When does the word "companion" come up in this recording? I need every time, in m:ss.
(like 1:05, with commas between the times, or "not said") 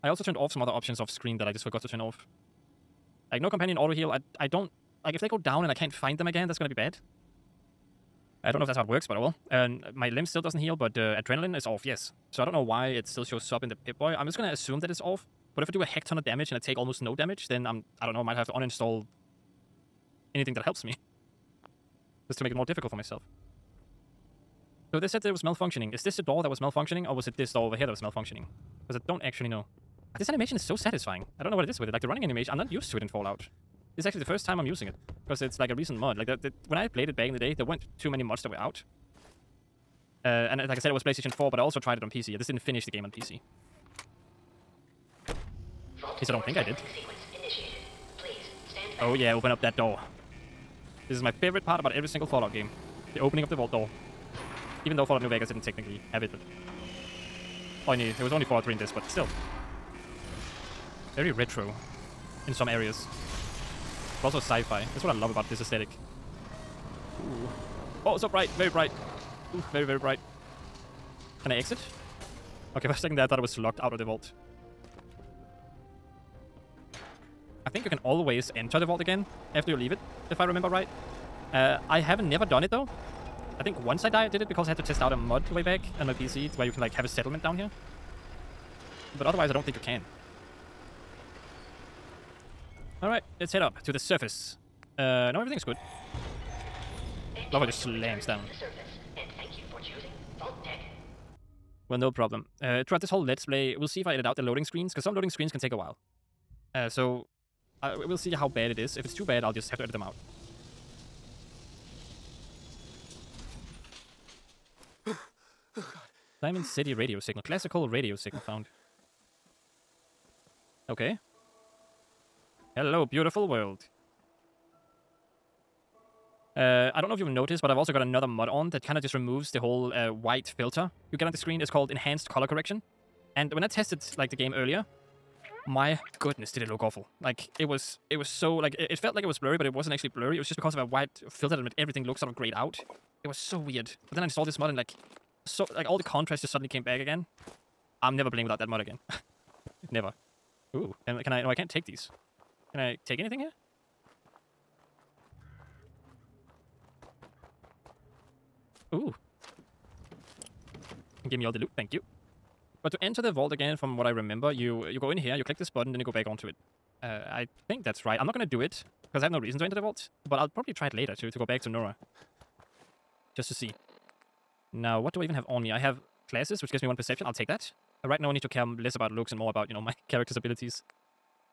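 0:03.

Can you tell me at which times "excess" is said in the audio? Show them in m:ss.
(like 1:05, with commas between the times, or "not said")
not said.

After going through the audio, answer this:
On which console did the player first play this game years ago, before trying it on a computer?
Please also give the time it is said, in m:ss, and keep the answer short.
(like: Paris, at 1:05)
PlayStation 4, at 0:41.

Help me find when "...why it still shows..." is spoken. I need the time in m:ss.
0:12.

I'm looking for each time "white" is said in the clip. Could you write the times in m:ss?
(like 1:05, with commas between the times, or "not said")
2:10, 2:20.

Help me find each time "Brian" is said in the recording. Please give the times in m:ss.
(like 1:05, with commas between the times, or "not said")
not said.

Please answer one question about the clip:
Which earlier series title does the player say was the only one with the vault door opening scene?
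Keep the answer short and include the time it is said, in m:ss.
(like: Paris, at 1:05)
Fallout 3, at 0:58.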